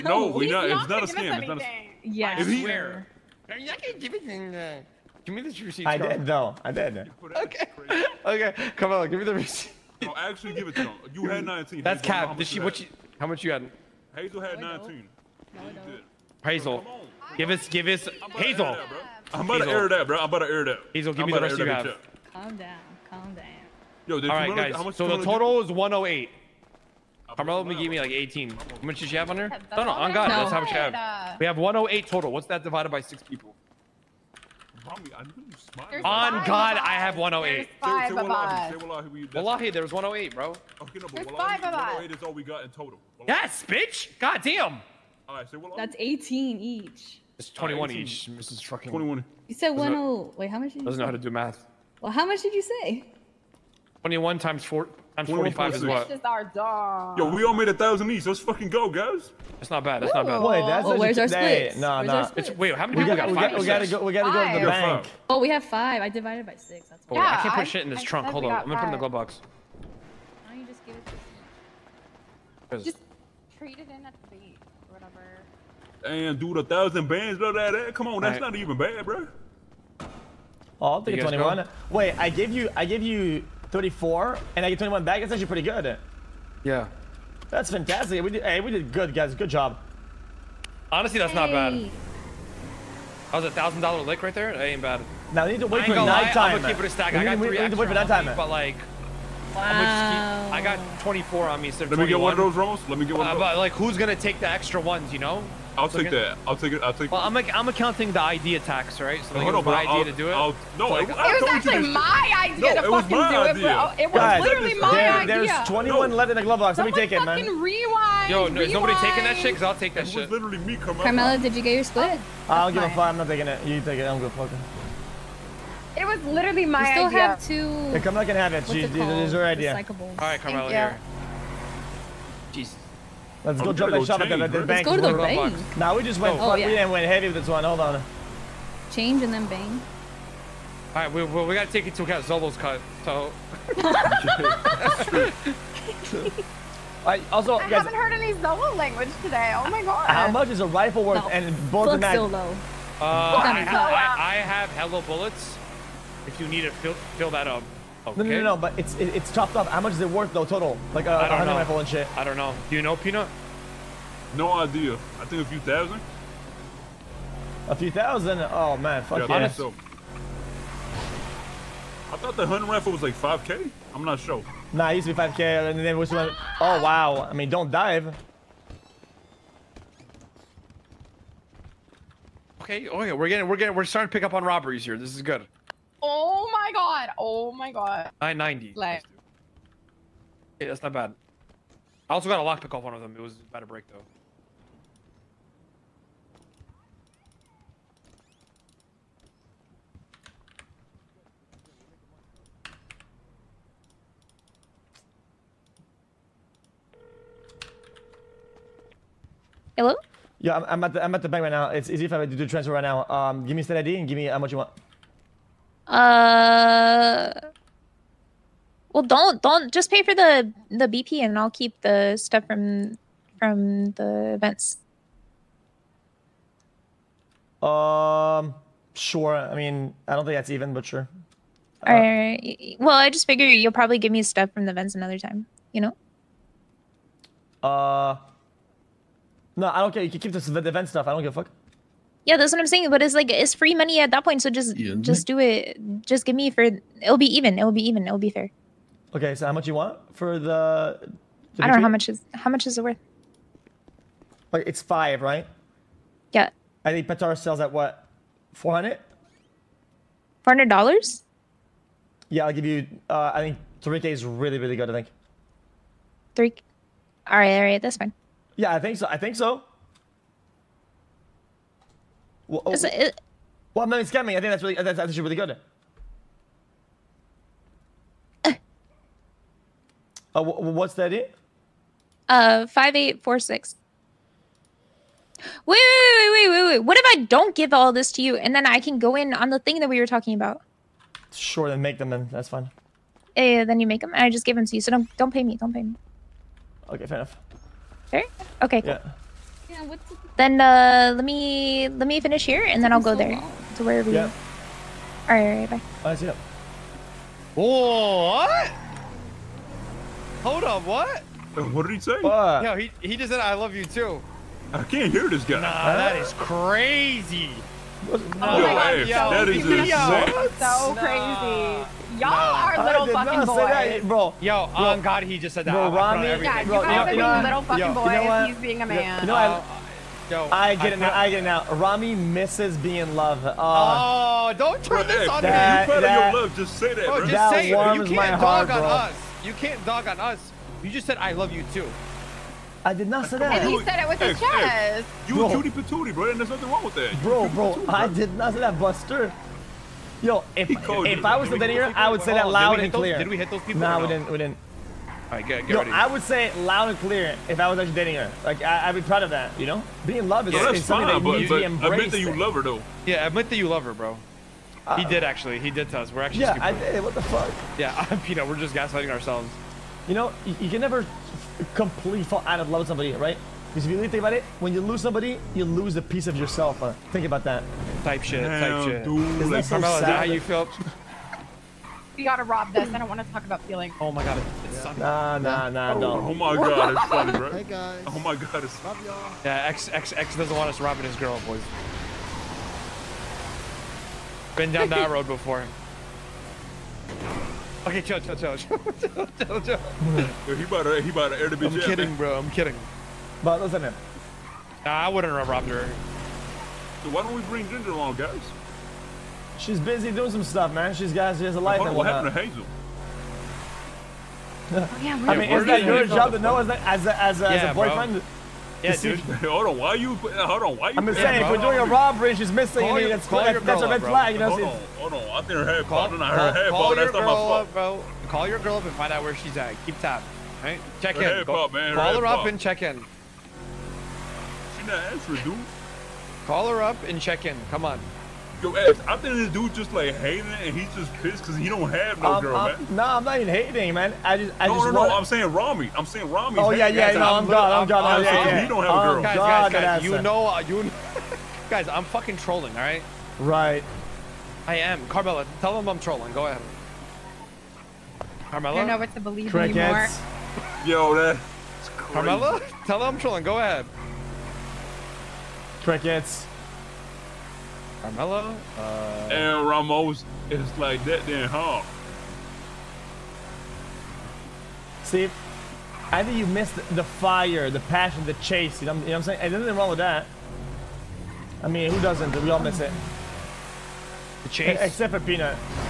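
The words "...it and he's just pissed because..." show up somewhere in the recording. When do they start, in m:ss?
7:20.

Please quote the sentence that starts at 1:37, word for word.
We I got three we need to wait for that time.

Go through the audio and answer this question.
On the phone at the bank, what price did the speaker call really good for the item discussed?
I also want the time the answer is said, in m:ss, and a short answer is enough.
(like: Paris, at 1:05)
3k, at 4:23.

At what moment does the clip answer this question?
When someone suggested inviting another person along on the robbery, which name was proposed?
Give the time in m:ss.
6:47.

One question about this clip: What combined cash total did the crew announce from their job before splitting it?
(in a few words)
108.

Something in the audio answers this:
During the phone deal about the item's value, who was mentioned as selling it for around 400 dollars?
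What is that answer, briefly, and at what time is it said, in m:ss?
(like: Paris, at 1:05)
Petar, at 4:17.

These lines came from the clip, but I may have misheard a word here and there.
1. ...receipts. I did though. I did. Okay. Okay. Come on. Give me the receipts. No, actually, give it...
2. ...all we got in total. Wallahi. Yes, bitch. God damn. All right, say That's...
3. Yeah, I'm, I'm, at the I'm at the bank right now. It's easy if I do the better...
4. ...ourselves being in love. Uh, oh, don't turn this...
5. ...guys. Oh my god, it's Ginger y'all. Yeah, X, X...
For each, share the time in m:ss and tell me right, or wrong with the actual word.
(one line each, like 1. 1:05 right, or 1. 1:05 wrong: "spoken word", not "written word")
1. 0:05 right
2. 0:42 right
3. 3:30 wrong: "transfer", not "better"
4. 5:32 wrong: "misses", not "ourselves"
5. 6:27 wrong: "Love", not "Ginger".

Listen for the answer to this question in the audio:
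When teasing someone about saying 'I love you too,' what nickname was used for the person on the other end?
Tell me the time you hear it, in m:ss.
5:45.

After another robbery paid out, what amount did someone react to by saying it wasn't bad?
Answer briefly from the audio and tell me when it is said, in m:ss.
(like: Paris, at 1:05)
990, at 3:08.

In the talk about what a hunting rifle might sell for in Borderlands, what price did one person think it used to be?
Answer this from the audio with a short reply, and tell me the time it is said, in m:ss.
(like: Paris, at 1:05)
5k, at 2:52.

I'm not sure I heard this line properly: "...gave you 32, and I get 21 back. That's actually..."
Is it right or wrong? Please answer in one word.
wrong.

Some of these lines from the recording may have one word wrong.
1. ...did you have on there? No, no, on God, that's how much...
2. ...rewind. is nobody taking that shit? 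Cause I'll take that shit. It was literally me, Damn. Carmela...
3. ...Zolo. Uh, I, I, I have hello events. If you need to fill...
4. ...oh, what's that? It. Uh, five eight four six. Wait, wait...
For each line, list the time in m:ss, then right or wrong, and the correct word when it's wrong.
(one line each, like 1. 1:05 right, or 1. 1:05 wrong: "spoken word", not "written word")
1. 0:28 right
2. 1:58 wrong: "Carmela", not "Damn"
3. 2:32 wrong: "bullets", not "events"
4. 4:40 right.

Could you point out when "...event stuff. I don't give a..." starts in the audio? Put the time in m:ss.
4:00.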